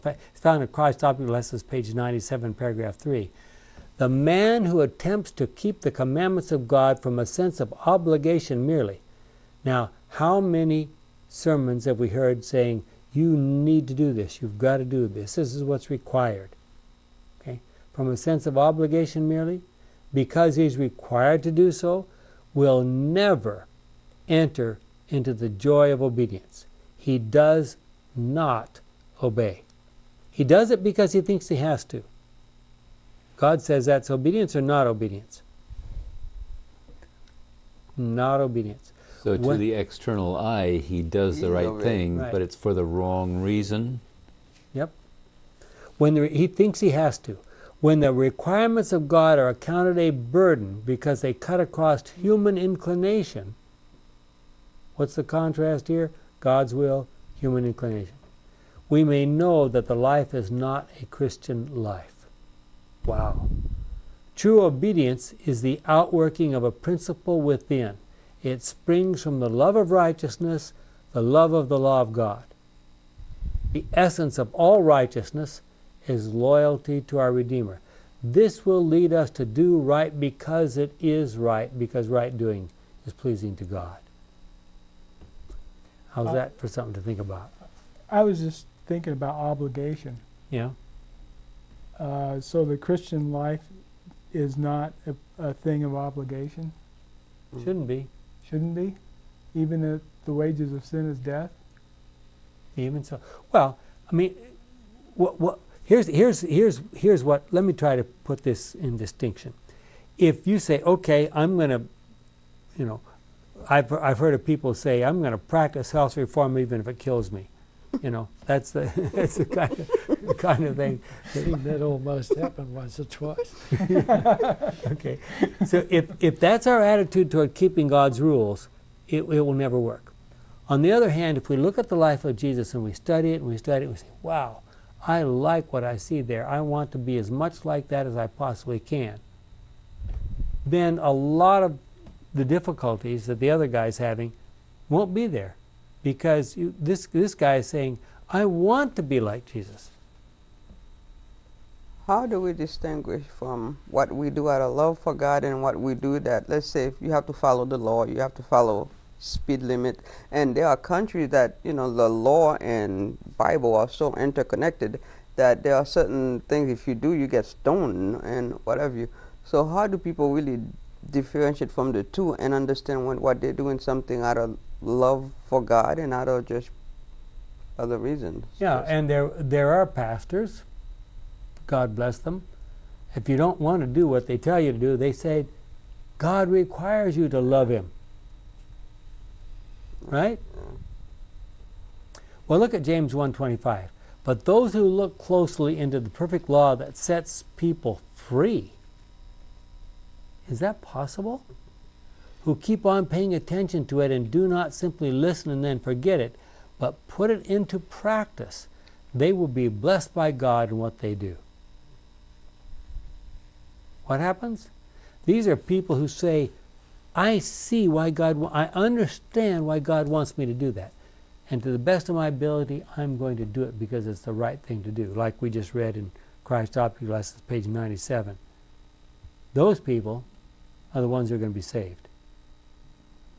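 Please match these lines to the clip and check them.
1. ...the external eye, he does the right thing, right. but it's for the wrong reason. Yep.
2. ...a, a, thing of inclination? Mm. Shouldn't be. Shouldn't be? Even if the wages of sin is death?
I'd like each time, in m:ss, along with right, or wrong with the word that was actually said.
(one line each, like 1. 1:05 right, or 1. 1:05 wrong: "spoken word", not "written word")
1. 0:39 right
2. 1:35 wrong: "obligation", not "inclination".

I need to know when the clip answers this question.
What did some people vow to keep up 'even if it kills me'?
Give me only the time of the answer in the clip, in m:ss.
1:55.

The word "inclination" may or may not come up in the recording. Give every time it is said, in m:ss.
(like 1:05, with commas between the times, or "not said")
0:52, 0:57.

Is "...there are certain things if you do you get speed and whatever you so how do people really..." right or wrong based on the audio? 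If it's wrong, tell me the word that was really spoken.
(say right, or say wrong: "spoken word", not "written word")
wrong: "stoned", not "speed".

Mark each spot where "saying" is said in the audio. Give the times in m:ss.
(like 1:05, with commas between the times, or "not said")
0:12, 2:27.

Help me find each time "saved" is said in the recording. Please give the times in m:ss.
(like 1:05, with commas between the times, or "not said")
3:51.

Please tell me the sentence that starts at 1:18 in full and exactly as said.
This will lead us to do right because it is right, because right doing is pleasing to God.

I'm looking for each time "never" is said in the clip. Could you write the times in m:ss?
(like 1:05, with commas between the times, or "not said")
0:22, 2:09.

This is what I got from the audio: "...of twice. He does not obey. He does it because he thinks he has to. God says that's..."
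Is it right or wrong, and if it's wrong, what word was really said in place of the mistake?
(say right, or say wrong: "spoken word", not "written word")
wrong: "obedience", not "twice".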